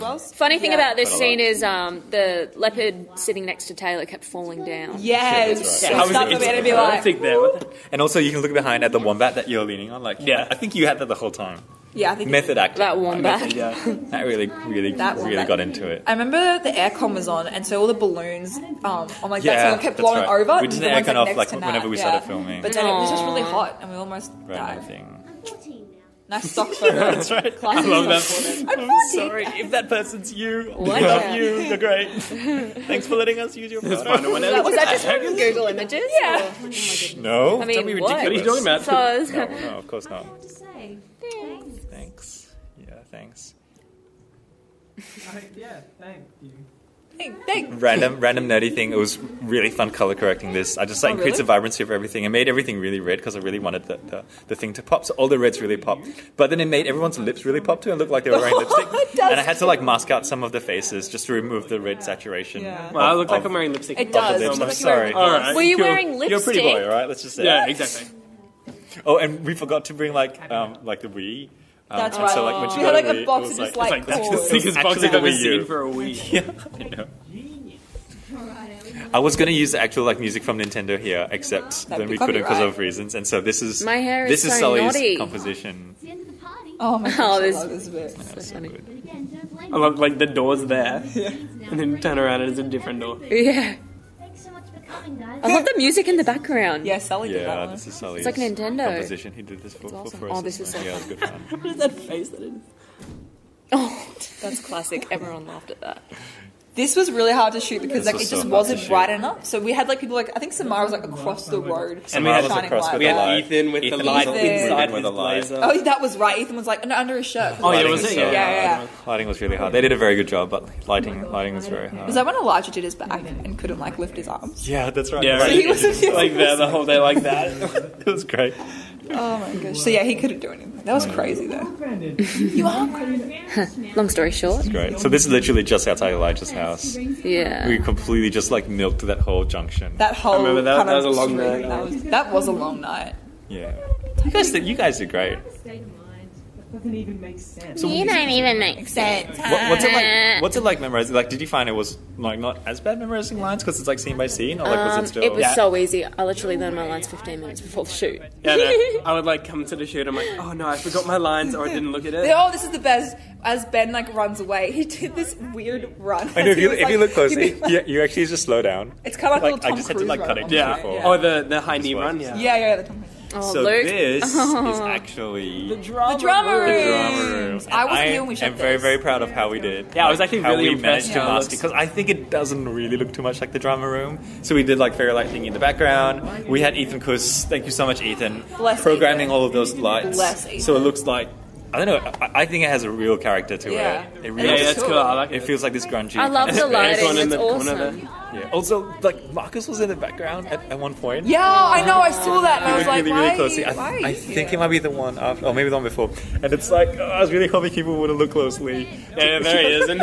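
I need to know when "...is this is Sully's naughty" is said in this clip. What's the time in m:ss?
1:24.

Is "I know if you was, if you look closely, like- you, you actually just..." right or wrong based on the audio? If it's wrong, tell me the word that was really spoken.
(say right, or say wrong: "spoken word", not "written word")
right.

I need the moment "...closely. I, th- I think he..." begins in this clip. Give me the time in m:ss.
3:23.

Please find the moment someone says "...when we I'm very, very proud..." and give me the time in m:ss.
2:58.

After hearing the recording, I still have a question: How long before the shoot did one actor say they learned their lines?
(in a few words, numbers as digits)
15 minutes.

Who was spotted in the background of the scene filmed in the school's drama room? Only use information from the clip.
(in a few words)
Marcus.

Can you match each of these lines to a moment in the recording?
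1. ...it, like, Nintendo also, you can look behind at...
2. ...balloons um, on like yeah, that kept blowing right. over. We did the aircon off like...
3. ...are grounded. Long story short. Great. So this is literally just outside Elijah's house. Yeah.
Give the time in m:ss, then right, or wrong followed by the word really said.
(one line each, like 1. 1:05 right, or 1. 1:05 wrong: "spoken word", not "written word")
1. 0:07 wrong: "And", not "Nintendo"
2. 0:17 right
3. 2:12 right.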